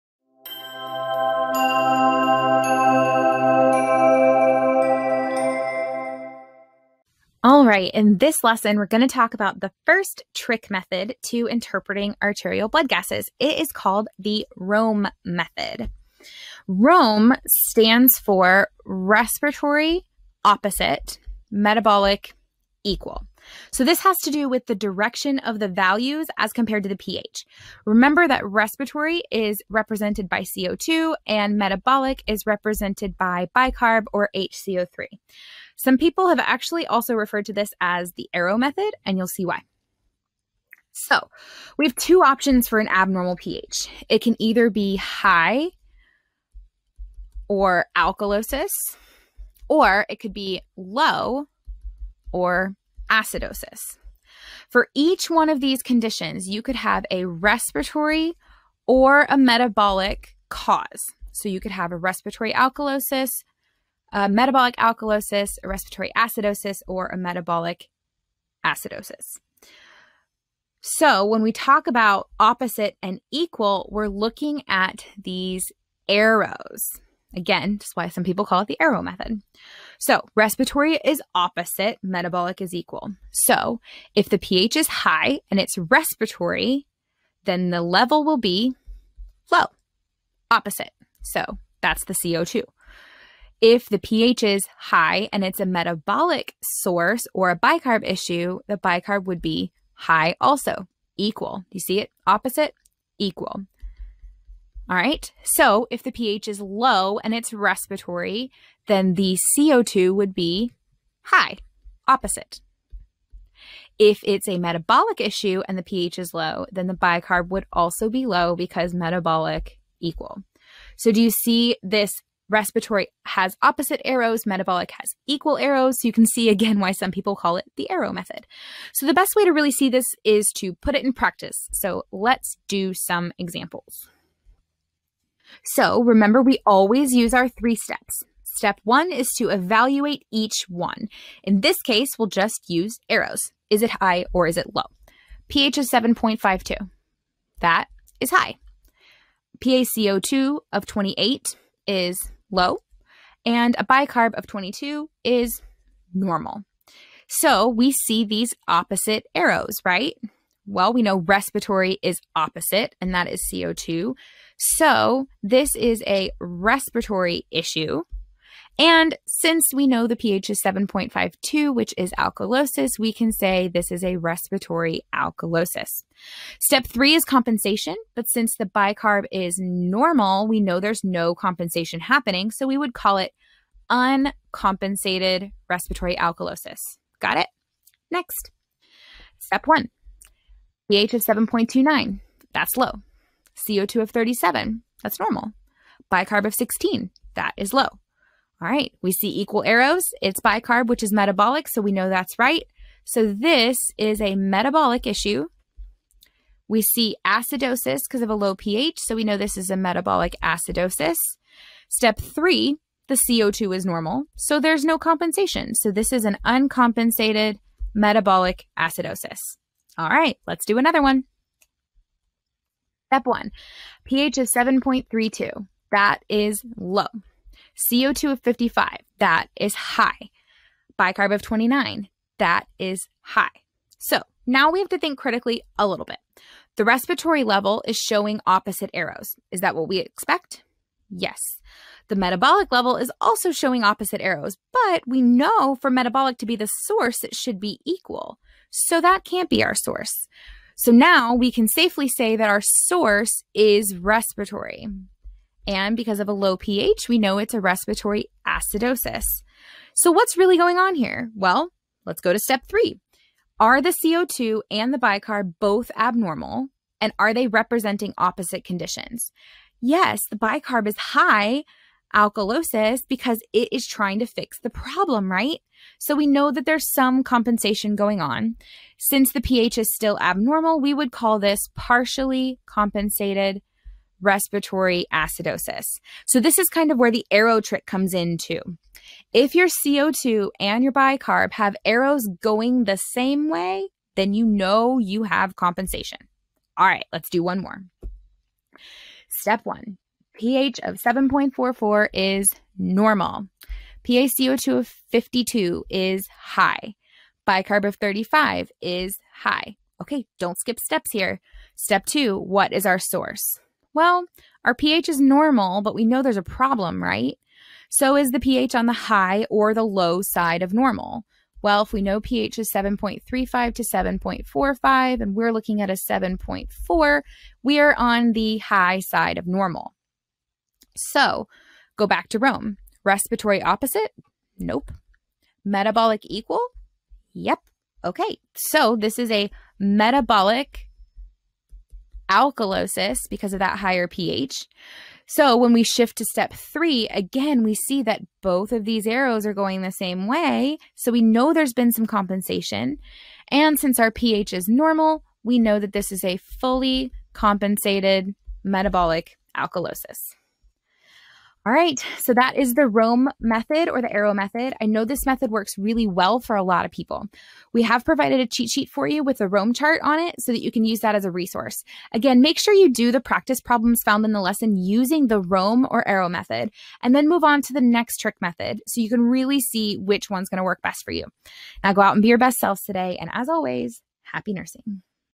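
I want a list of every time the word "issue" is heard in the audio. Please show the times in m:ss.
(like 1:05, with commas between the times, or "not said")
1:38, 1:55, 2:47, 3:25.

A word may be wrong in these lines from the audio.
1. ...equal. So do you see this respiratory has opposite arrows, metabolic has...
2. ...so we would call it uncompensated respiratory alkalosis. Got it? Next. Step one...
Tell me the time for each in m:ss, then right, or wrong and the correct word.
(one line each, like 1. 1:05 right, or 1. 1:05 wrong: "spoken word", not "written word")
1. 1:59 right
2. 3:02 right.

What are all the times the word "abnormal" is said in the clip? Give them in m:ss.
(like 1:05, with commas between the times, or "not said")
0:42, 4:25, 4:40.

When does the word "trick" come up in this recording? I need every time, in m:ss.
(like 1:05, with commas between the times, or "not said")
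0:10, 4:47, 6:18.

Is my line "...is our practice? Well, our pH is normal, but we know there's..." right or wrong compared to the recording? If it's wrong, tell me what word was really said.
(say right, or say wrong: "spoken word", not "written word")
wrong: "source", not "practice".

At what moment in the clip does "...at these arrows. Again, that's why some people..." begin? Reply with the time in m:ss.
1:14.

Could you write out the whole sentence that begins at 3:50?
Bicarb of 29, that is high.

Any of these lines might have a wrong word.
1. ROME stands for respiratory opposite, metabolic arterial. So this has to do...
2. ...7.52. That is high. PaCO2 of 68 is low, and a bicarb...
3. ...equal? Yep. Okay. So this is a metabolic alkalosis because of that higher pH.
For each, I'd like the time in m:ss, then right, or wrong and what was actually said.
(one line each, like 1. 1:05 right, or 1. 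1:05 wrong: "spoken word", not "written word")
1. 0:16 wrong: "equal", not "arterial"
2. 2:25 wrong: "28", not "68"
3. 5:36 right.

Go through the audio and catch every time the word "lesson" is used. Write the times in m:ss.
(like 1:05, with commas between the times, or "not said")
0:08, 6:14.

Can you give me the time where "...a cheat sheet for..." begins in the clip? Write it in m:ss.
6:08.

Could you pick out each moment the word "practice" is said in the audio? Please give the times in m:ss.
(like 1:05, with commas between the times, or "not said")
2:11, 6:13.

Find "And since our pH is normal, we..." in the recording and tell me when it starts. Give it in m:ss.
5:53.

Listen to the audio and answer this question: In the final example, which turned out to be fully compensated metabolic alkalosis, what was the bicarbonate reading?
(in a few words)
35.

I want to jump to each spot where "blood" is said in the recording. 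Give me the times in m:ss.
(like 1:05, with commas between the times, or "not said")
0:12.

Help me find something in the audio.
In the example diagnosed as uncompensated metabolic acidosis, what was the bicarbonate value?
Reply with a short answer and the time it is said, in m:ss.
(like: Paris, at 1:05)
16, at 3:16.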